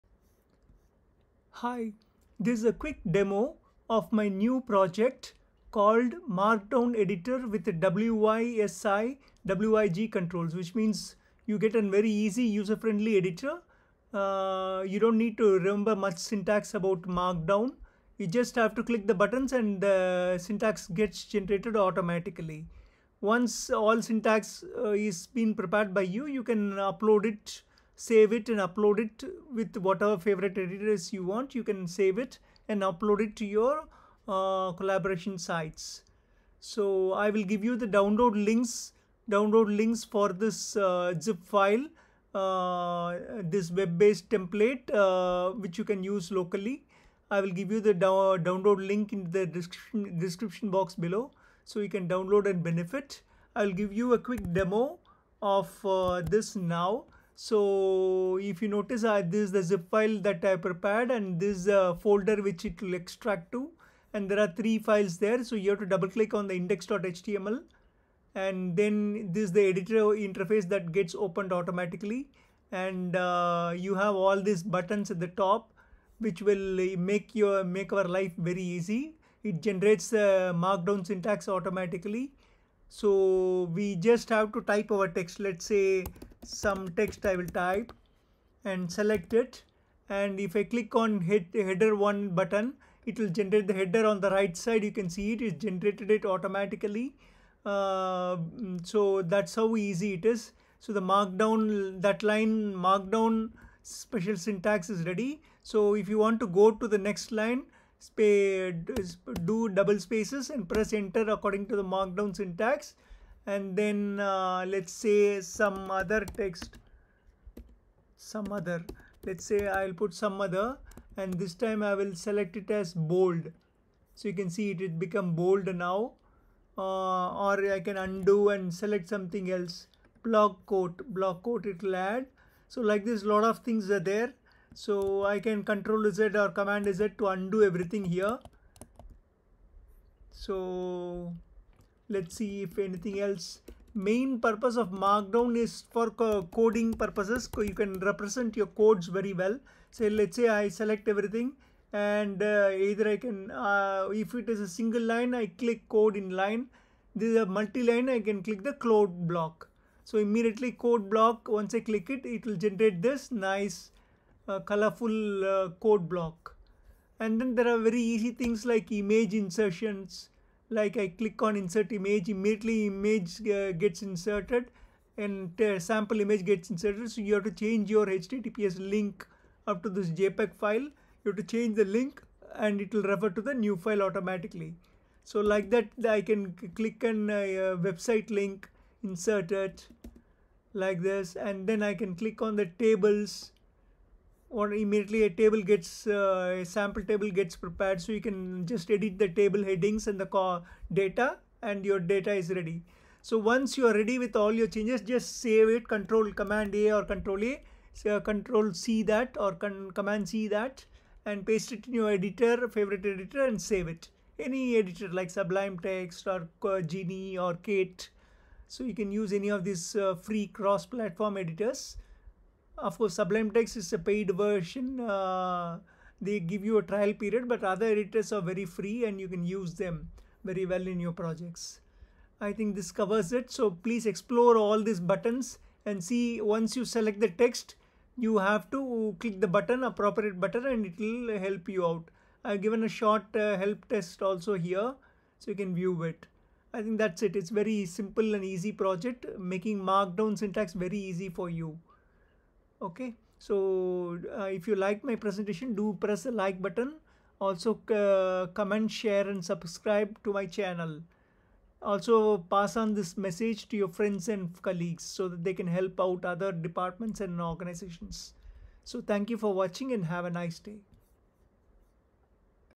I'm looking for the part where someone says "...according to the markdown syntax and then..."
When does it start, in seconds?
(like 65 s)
111 s.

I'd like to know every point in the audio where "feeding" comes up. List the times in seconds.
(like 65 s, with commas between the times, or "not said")
not said.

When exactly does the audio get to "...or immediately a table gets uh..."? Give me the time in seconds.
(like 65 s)
194 s.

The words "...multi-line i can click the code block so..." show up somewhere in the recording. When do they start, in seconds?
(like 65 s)
157 s.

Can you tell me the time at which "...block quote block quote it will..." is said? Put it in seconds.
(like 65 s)
130 s.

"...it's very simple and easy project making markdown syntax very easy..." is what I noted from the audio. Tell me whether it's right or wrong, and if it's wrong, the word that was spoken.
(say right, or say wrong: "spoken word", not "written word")
right.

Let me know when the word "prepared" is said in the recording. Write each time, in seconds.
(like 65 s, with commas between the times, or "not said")
25 s, 60 s, 197 s.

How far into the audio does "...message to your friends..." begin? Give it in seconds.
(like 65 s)
263 s.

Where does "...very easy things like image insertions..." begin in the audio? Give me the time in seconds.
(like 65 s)
167 s.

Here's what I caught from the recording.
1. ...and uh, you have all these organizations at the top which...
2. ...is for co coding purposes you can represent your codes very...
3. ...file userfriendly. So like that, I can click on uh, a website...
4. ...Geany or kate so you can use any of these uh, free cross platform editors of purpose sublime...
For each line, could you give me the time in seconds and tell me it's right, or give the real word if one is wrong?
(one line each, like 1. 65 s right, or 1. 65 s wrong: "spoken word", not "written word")
1. 72 s wrong: "buttons", not "organizations"
2. 145 s right
3. 183 s wrong: "automatically", not "userfriendly"
4. 216 s wrong: "course", not "purpose".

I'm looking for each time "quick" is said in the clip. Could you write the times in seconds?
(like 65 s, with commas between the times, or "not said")
2 s, 54 s.